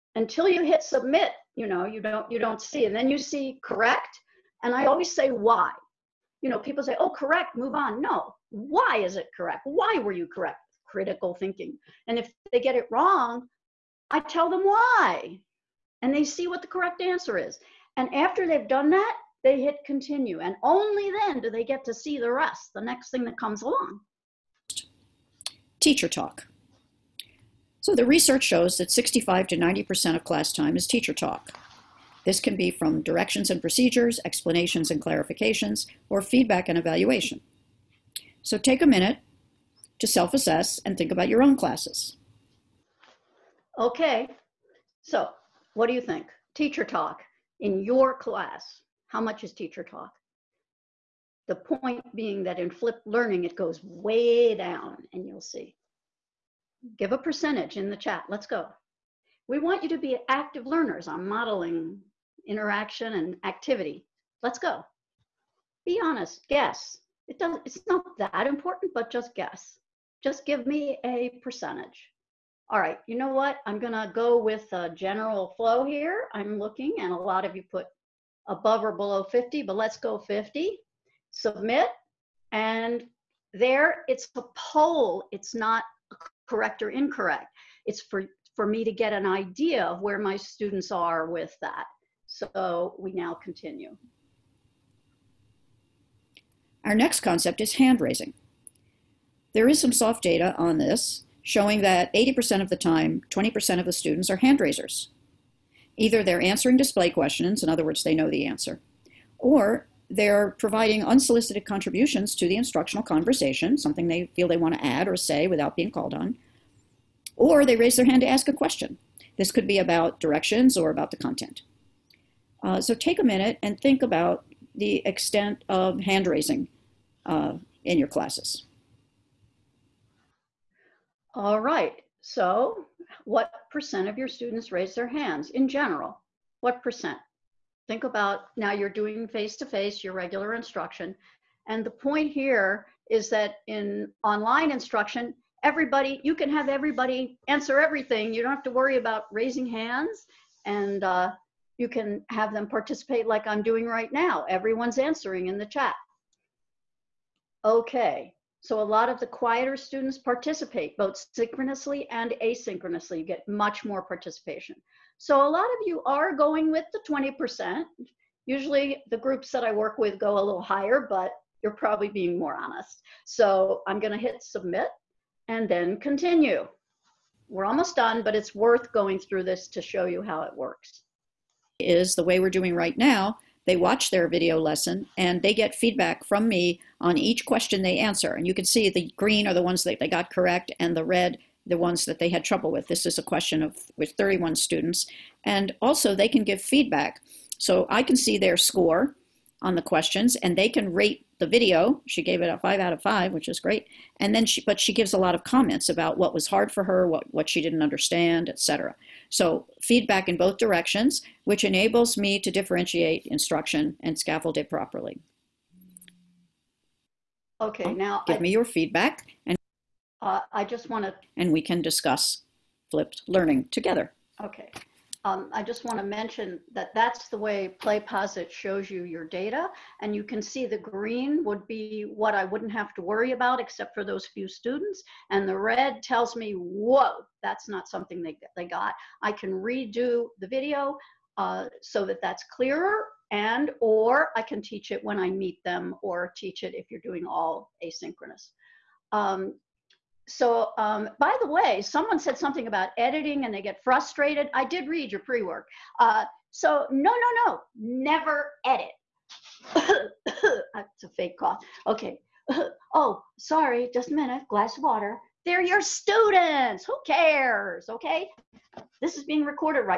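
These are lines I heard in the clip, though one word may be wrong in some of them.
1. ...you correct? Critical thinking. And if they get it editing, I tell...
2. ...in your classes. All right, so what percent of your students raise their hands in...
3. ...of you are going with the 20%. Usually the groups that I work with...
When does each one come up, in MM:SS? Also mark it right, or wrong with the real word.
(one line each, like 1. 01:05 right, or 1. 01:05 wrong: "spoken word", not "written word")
1. 00:10 wrong: "wrong", not "editing"
2. 02:07 right
3. 02:45 right.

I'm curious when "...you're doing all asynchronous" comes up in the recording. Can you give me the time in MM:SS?
04:06.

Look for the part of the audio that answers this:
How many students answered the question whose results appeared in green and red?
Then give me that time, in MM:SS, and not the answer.
03:14.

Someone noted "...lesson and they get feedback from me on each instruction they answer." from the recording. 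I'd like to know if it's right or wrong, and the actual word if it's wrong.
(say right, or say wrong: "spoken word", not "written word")
wrong: "question", not "instruction".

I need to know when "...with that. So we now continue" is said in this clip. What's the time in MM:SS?
01:31.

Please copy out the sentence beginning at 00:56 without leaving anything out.
Give a percentage in the chat.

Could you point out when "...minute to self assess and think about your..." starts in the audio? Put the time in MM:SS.
00:38.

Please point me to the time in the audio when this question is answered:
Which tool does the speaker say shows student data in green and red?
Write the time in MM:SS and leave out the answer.
03:47.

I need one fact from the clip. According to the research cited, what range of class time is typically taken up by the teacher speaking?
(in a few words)
65 to 90%.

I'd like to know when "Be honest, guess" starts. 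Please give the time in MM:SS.
01:05.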